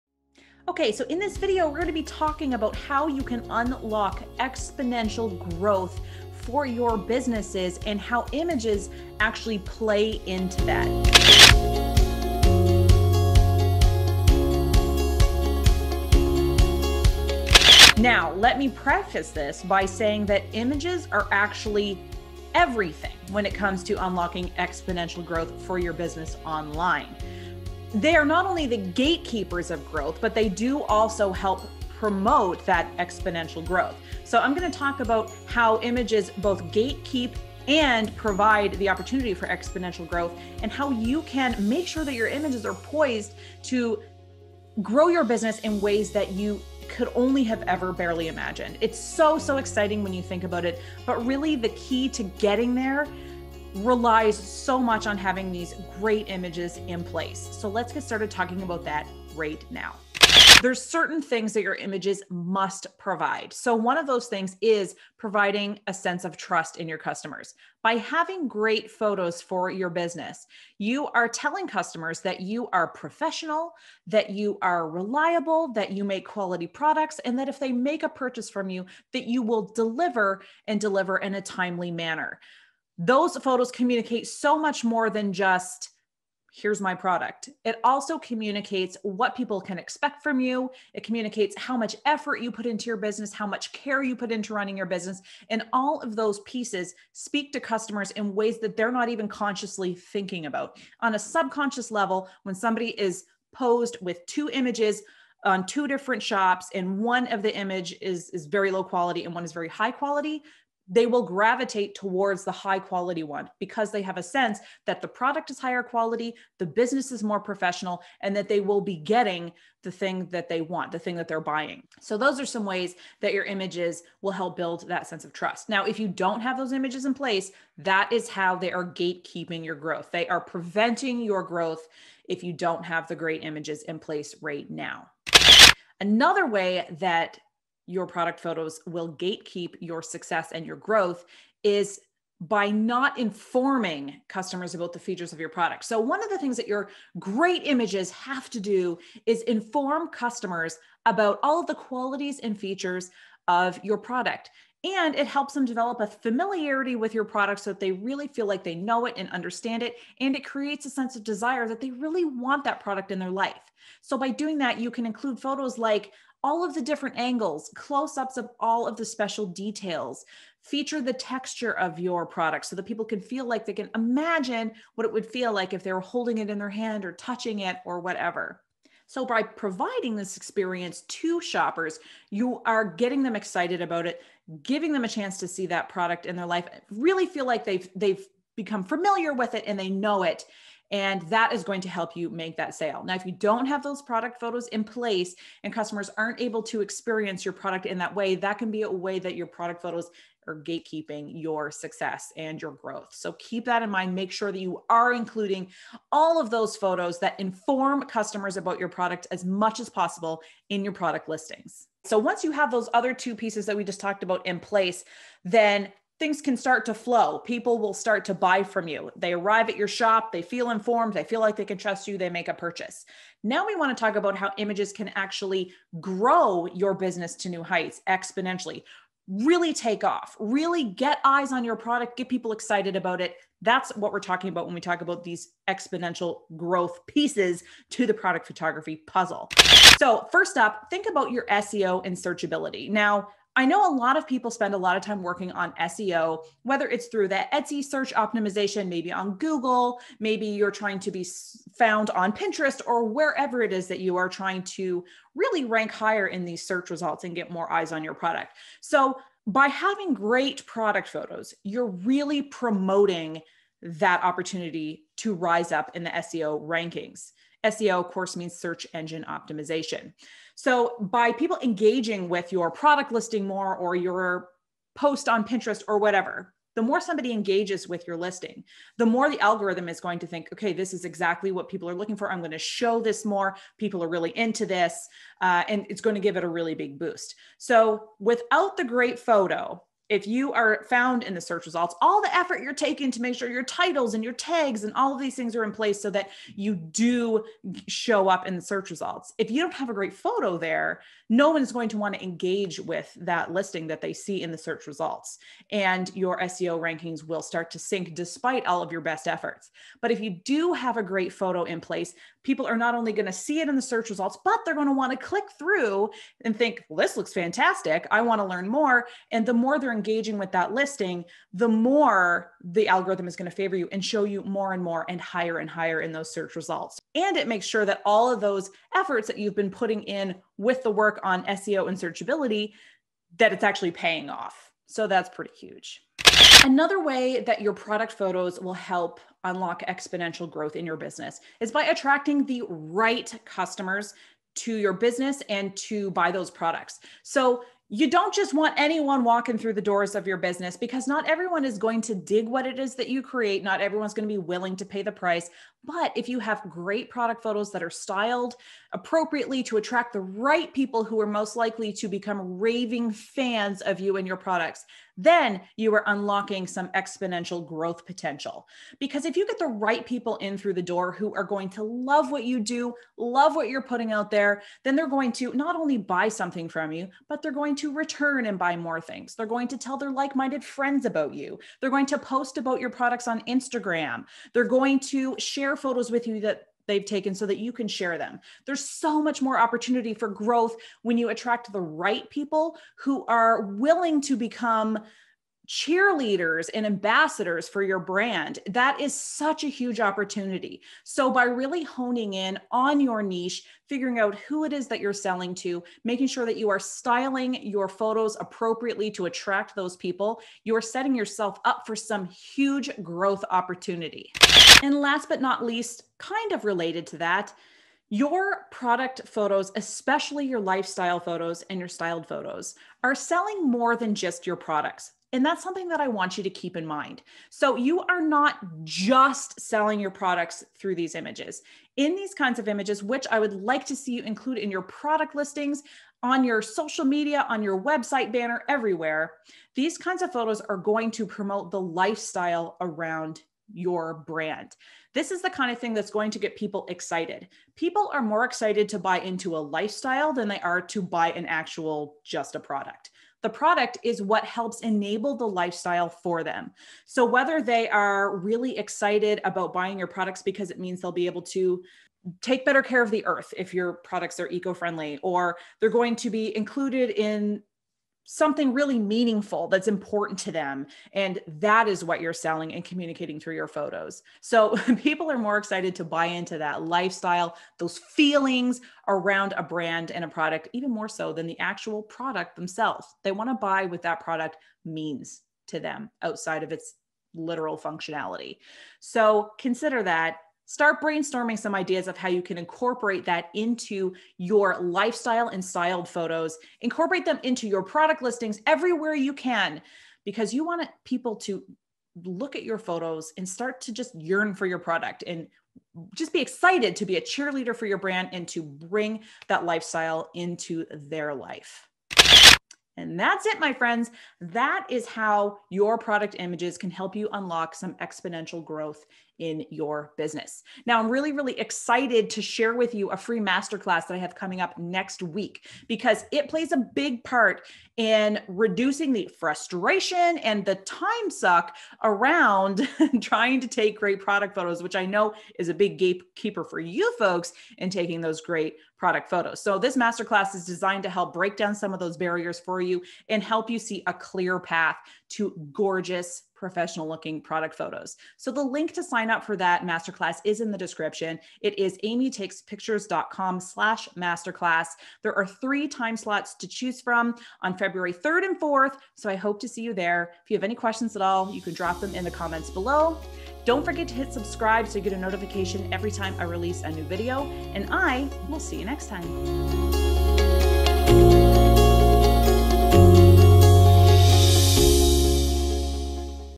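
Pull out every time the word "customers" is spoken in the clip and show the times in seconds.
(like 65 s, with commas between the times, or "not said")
66 s, 71 s, 97 s, 144 s, 150 s, 195 s, 208 s, 343 s.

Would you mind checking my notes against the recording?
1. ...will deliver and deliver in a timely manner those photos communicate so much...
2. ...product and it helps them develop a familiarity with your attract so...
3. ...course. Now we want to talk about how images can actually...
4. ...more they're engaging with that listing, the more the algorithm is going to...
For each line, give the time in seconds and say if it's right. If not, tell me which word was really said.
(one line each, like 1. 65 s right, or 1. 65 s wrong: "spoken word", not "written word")
1. 79 s right
2. 153 s wrong: "product", not "attract"
3. 222 s wrong: "purchase", not "course"
4. 319 s right.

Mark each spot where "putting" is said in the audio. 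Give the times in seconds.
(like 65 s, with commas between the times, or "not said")
329 s, 373 s.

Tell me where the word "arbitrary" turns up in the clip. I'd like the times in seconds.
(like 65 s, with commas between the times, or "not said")
not said.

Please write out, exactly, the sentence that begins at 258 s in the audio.
So, by having great product photos, you're really promoting that opportunity to rise up in the SEO rankings.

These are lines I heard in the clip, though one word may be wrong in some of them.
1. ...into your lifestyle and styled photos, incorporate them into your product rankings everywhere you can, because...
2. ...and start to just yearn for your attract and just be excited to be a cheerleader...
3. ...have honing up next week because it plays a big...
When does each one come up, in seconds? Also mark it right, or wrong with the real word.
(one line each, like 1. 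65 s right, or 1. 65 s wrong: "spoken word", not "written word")
1. 493 s wrong: "listings", not "rankings"
2. 503 s wrong: "product", not "attract"
3. 524 s wrong: "coming", not "honing".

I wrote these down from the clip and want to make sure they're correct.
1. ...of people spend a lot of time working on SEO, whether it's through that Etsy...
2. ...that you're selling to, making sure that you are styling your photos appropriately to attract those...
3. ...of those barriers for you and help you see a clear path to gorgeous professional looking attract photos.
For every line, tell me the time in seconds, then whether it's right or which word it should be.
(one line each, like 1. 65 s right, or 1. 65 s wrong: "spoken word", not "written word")
1. 244 s right
2. 404 s right
3. 541 s wrong: "product", not "attract".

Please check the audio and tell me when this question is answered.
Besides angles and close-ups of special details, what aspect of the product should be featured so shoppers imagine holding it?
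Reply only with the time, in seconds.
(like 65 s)
171 s.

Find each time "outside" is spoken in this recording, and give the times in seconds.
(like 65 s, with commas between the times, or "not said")
486 s.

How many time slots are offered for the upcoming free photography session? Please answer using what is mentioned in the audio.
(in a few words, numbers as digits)
3.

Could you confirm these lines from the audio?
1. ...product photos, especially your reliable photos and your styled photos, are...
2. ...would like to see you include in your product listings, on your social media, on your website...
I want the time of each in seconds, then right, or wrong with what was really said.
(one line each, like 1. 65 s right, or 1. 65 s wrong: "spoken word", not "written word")
1. 418 s wrong: "lifestyle", not "reliable"
2. 433 s right.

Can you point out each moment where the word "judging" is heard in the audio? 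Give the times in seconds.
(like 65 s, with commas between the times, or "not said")
not said.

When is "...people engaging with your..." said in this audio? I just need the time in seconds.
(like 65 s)
271 s.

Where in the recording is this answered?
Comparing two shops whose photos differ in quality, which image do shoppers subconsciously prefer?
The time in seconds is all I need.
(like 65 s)
112 s.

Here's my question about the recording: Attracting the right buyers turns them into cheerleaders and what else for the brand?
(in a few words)
ambassadors.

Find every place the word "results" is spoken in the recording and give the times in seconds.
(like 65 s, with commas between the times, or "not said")
256 s, 291 s, 298 s, 304 s, 314 s, 326 s.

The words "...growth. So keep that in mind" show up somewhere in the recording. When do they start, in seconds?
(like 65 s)
202 s.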